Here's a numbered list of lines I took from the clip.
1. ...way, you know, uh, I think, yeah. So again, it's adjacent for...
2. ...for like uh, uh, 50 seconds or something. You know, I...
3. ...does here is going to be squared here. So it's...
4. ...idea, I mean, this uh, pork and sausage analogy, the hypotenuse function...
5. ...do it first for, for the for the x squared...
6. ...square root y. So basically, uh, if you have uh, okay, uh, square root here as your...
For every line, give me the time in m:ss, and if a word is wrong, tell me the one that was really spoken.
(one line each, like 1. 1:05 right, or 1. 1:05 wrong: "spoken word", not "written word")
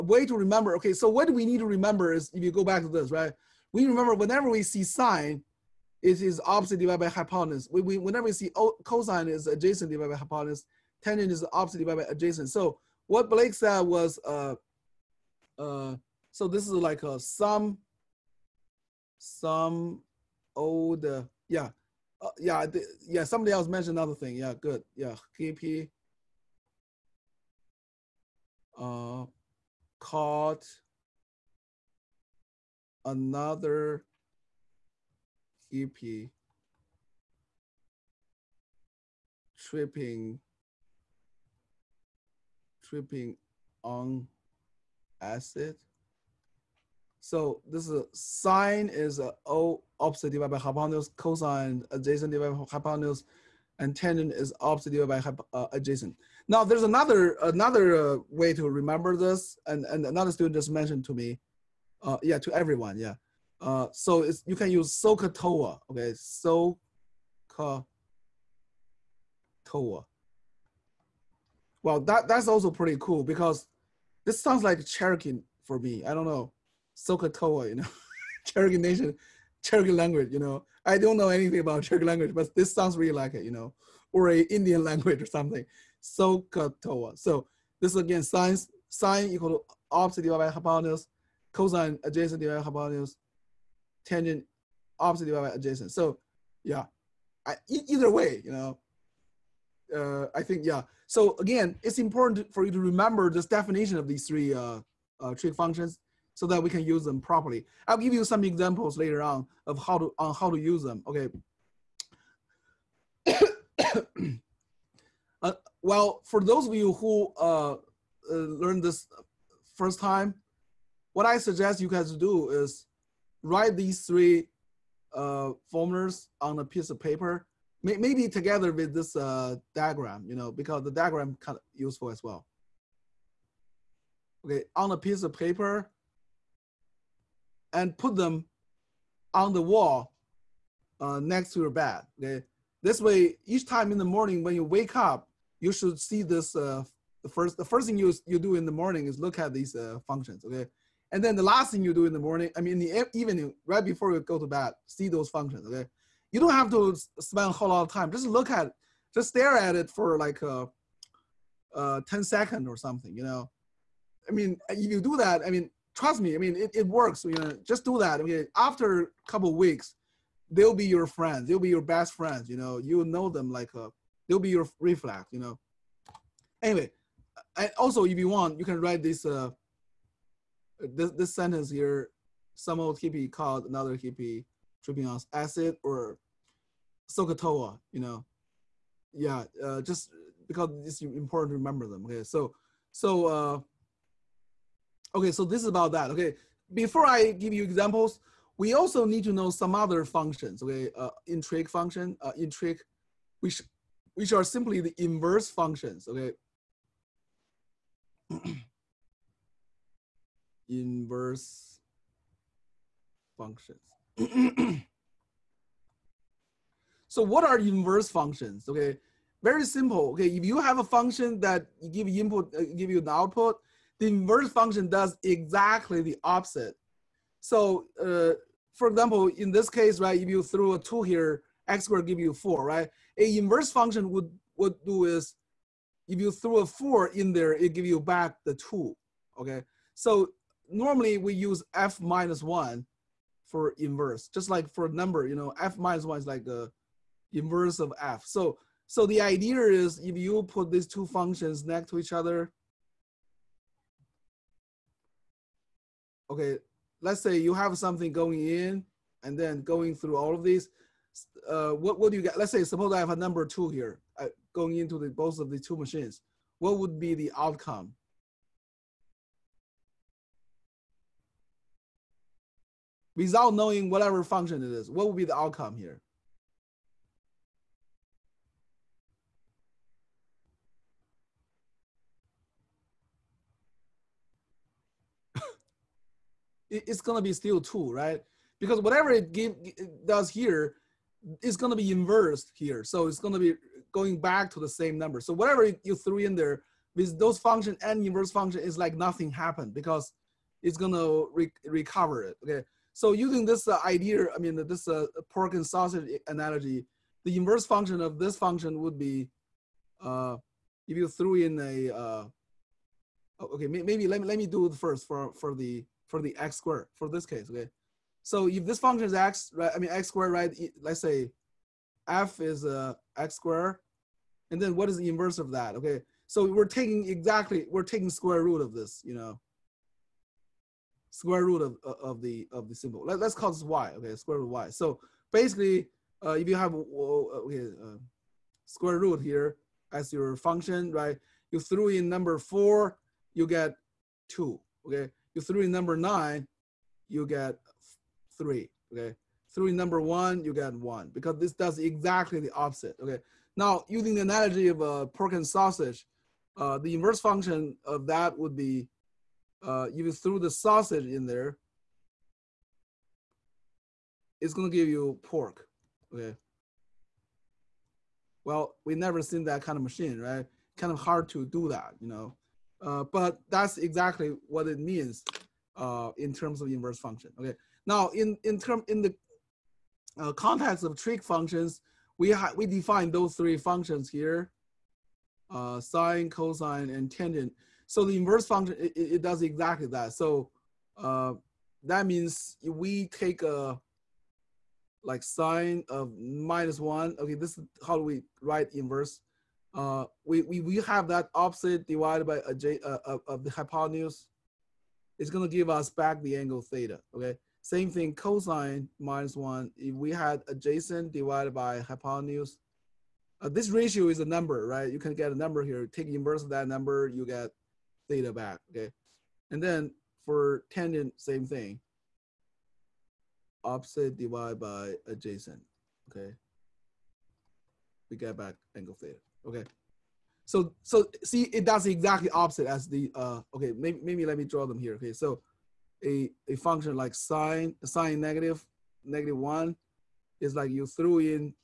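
1. 1:38 wrong: "important", not "adjacent"
2. 2:39 wrong: "10", not "50"
3. 4:50 wrong: "inversed", not "squared"
4. 5:03 wrong: "inverse", not "hypotenuse"
5. 5:14 right
6. 5:34 right.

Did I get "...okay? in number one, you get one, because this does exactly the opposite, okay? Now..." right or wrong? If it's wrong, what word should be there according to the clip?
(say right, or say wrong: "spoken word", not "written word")
right.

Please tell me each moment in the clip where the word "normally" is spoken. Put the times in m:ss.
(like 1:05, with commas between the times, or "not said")
4:00.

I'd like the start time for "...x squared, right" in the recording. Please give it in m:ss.
5:19.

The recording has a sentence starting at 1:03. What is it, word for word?
Uh, so it's, you can use SOHCAHTOA, okay, SOHCAHTOA.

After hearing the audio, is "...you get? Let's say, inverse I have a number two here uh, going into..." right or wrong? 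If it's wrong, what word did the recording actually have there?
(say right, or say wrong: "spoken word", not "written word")
wrong: "suppose", not "inverse".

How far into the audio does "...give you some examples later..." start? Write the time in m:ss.
1:47.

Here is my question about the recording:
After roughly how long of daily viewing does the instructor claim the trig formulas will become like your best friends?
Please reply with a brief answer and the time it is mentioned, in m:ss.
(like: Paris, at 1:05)
A couple weeks, at 2:49.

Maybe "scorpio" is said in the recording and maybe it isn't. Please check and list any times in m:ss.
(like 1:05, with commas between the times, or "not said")
not said.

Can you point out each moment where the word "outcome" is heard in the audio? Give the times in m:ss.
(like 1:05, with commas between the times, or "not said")
4:27, 4:35.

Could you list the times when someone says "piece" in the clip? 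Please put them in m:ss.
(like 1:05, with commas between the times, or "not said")
2:06, 2:14.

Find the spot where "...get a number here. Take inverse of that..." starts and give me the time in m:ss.
6:55.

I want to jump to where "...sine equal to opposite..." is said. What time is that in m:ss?
1:28.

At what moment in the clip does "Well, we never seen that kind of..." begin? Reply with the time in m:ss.
6:08.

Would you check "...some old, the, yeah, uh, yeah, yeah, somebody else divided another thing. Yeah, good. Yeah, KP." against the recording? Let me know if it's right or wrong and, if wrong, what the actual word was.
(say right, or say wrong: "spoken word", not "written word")
wrong: "mentioned", not "divided".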